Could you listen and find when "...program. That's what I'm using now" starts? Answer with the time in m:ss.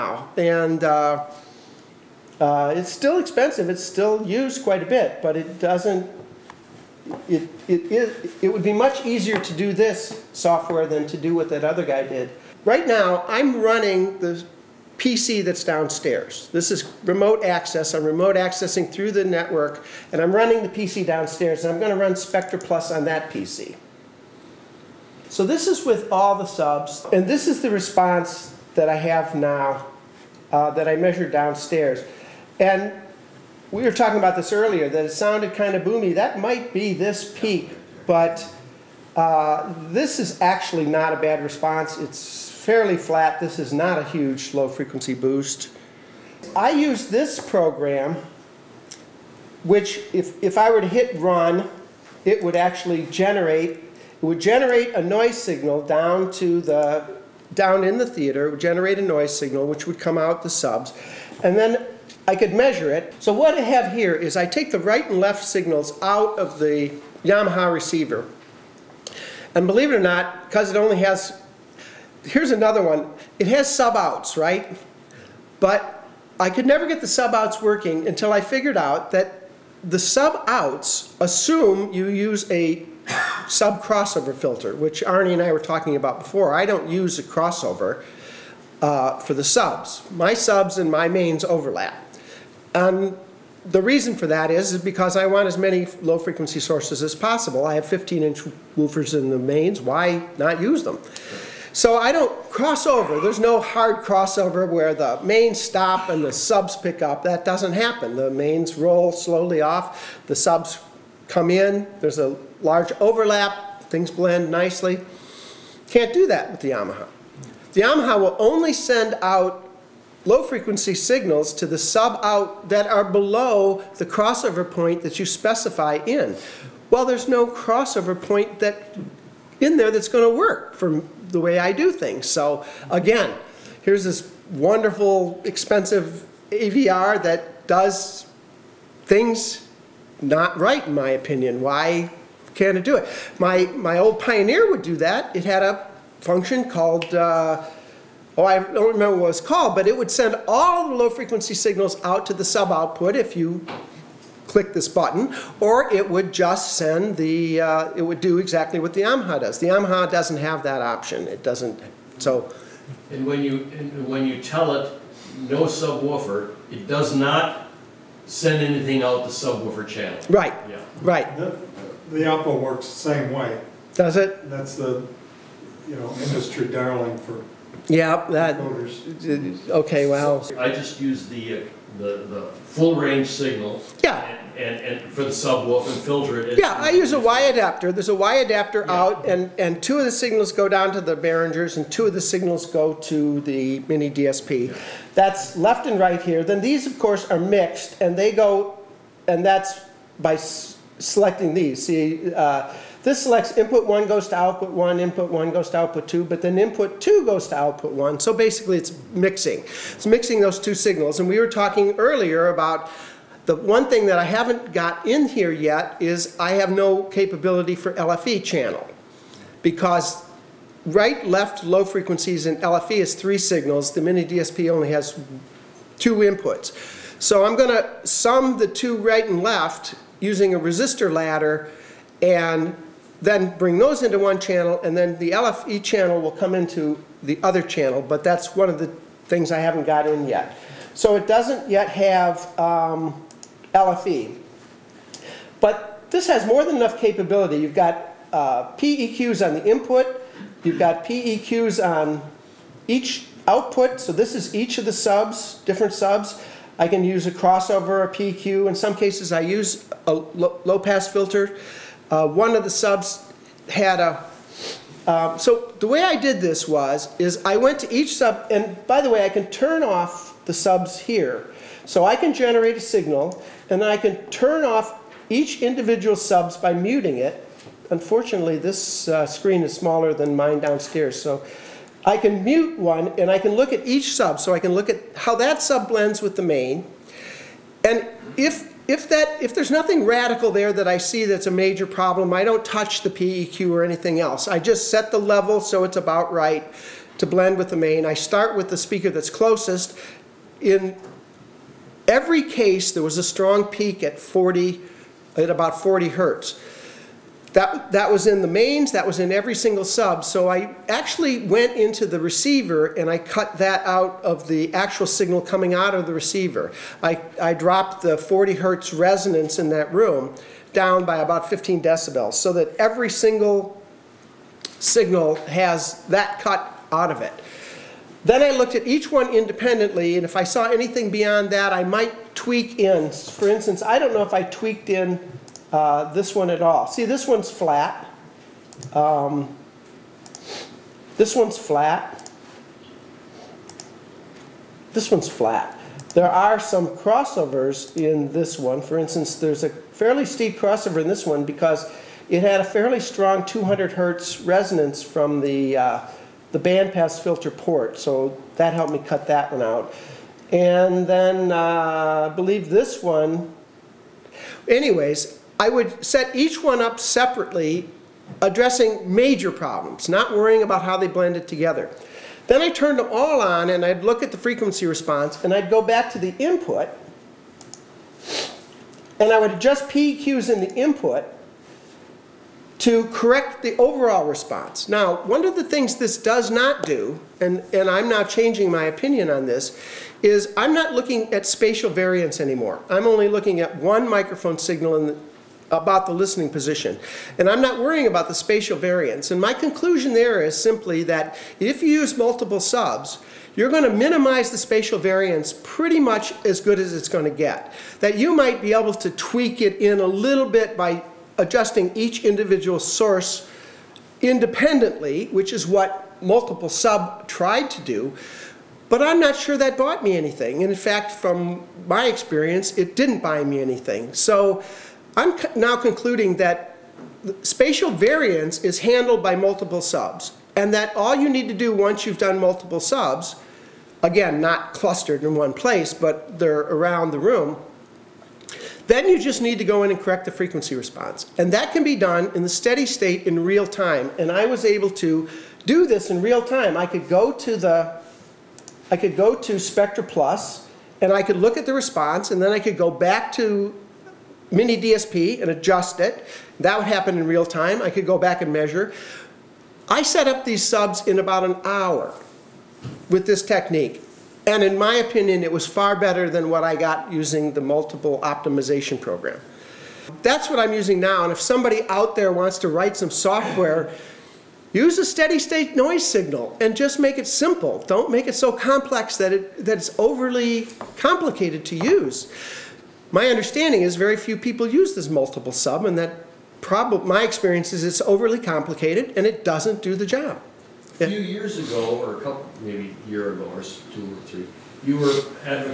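7:49.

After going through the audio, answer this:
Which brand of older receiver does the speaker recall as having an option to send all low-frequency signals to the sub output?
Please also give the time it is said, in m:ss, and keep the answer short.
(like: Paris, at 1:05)
Pioneer, at 2:24.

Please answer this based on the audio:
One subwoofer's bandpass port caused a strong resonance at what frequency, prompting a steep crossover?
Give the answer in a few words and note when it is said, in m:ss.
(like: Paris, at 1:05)
200 Hz, at 5:53.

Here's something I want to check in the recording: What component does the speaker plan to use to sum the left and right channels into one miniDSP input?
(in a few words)
resistor ladder.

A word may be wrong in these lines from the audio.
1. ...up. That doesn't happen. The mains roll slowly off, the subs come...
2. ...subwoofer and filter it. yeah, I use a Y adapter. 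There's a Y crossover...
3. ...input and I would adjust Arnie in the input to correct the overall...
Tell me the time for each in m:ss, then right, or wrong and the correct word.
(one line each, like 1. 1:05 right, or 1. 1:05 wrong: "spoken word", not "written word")
1. 1:47 right
2. 3:05 wrong: "adapter", not "crossover"
3. 6:16 wrong: "PEQs", not "Arnie".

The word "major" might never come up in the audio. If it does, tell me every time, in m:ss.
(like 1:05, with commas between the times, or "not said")
4:51, 6:09.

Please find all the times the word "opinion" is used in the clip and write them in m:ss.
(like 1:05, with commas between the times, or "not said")
2:21, 6:28, 7:44.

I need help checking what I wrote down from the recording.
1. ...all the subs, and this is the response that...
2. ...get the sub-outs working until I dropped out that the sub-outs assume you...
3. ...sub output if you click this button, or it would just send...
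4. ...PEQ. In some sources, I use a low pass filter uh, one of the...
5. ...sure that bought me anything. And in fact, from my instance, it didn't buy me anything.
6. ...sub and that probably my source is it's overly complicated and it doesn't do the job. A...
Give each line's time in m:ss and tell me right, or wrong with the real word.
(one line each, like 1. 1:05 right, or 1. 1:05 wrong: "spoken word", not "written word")
1. 0:26 right
2. 1:16 wrong: "figured", not "dropped"
3. 2:32 right
4. 4:18 wrong: "cases", not "sources"
5. 6:59 wrong: "experience", not "instance"
6. 8:05 wrong: "experience", not "source".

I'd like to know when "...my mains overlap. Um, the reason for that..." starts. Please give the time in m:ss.
1:30.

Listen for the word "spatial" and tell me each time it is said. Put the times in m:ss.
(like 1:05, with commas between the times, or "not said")
6:31, 6:38, 6:44, 7:07.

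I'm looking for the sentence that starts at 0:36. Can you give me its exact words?
That might be this peak, but uh, this is actually not a bad response.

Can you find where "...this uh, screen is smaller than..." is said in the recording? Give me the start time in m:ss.
4:38.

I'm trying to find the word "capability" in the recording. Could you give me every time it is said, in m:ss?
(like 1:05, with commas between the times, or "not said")
3:37, 4:06.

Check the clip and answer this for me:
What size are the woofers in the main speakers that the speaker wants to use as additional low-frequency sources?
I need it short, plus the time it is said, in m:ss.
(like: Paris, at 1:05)
15 inch, at 1:37.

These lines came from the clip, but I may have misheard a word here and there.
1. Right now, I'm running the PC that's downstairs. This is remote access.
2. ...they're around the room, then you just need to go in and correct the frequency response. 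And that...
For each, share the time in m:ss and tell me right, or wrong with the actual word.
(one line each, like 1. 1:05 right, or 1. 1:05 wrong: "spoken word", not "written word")
1. 0:12 right
2. 7:16 right.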